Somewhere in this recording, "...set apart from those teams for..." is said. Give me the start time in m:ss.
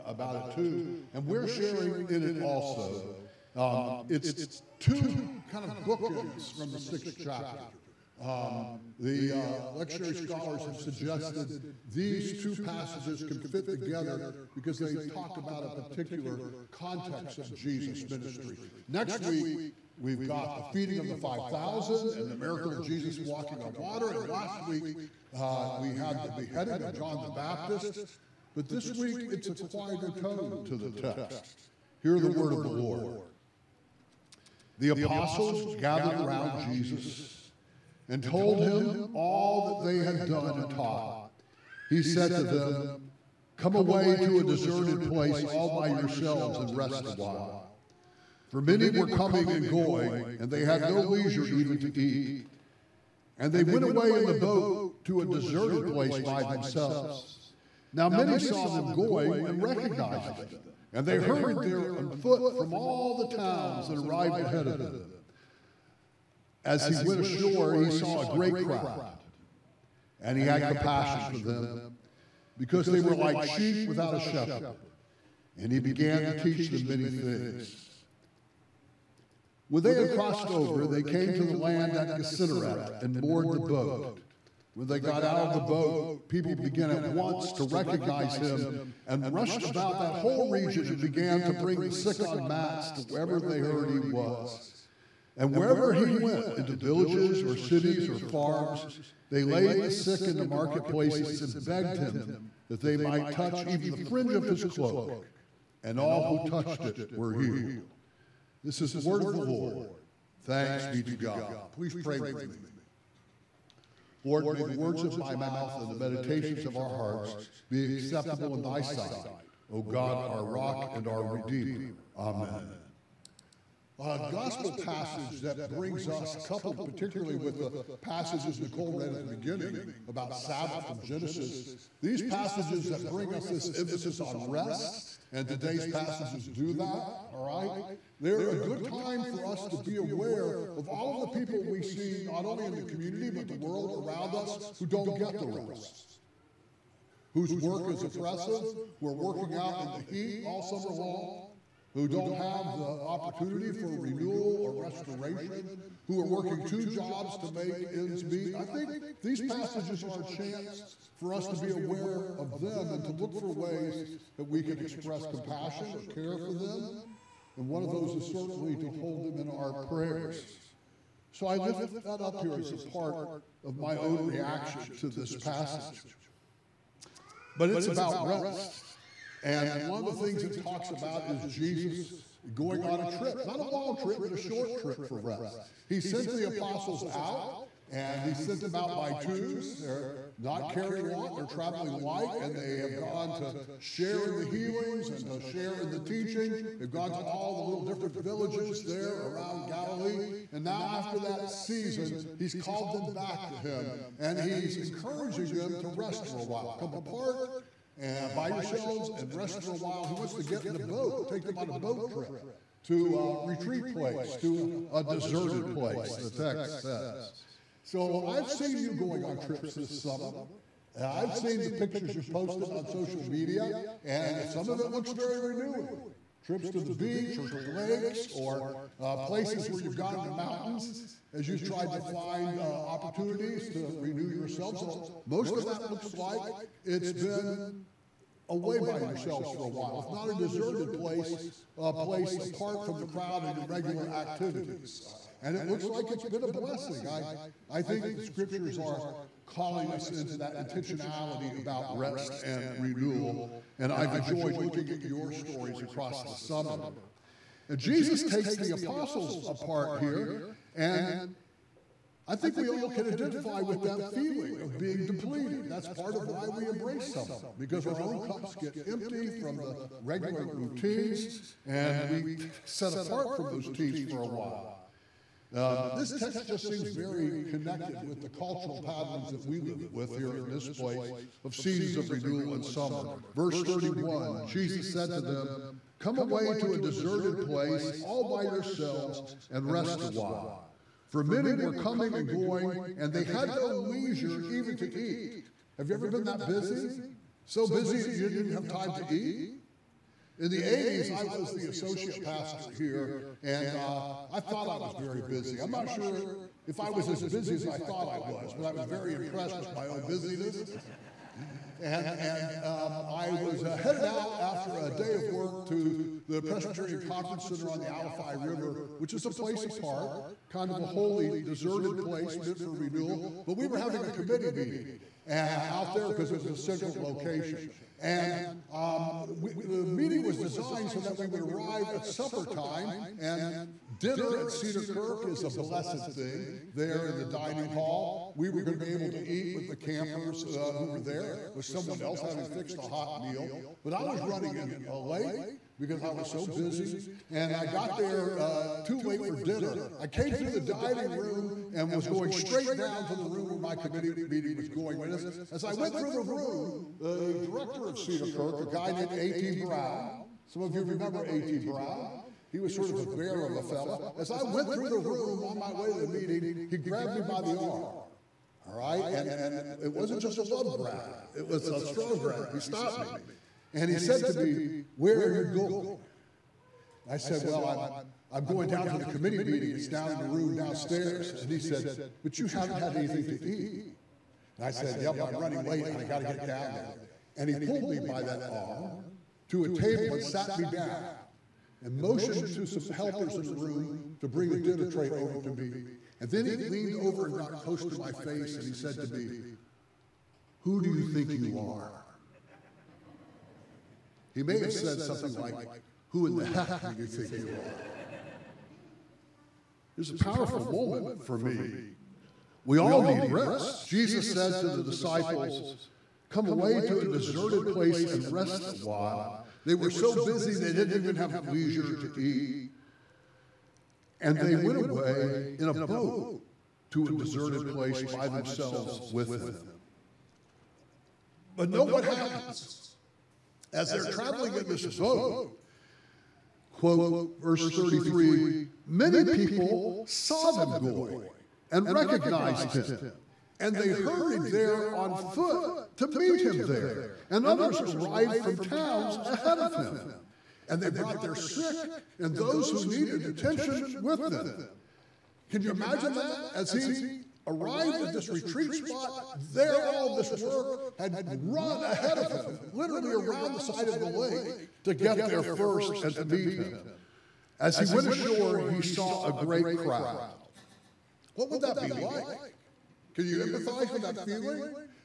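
4:32.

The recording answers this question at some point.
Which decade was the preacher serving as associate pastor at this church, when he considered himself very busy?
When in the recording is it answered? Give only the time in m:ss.
5:00.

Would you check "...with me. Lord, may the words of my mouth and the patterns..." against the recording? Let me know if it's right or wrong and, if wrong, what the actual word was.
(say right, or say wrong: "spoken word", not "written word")
wrong: "meditations", not "patterns".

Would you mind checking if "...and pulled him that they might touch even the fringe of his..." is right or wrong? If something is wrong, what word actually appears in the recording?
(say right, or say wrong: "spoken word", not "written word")
wrong: "begged", not "pulled".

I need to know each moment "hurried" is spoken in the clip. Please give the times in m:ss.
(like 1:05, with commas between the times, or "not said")
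1:01, 7:23.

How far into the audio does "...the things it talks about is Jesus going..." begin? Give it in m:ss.
3:00.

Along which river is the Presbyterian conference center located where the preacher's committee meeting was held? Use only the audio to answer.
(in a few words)
Alafia River.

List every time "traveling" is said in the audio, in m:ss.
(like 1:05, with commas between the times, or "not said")
3:11, 7:14.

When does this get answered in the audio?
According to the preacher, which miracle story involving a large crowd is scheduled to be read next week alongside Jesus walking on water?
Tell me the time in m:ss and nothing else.
0:20.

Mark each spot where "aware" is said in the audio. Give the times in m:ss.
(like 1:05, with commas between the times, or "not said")
2:19, 2:41.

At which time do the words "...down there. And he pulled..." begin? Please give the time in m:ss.
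6:26.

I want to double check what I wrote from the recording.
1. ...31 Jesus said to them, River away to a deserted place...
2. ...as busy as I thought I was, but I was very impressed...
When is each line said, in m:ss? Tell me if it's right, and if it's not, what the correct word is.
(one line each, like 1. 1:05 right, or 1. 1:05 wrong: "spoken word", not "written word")
1. 4:43 wrong: "Come", not "River"
2. 5:07 right.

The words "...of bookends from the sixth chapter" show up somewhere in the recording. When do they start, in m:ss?
0:05.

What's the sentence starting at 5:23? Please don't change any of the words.
But we were having a committee meeting uh, out there because it was a central location.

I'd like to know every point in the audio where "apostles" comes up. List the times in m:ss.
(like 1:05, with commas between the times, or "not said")
0:34, 3:06, 4:18.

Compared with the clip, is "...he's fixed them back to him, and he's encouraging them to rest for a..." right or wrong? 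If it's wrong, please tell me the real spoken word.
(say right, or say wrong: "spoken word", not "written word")
wrong: "called", not "fixed".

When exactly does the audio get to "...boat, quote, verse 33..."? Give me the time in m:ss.
7:14.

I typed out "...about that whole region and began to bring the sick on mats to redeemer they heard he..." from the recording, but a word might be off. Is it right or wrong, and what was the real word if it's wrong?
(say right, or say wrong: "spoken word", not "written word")
wrong: "wherever", not "redeemer".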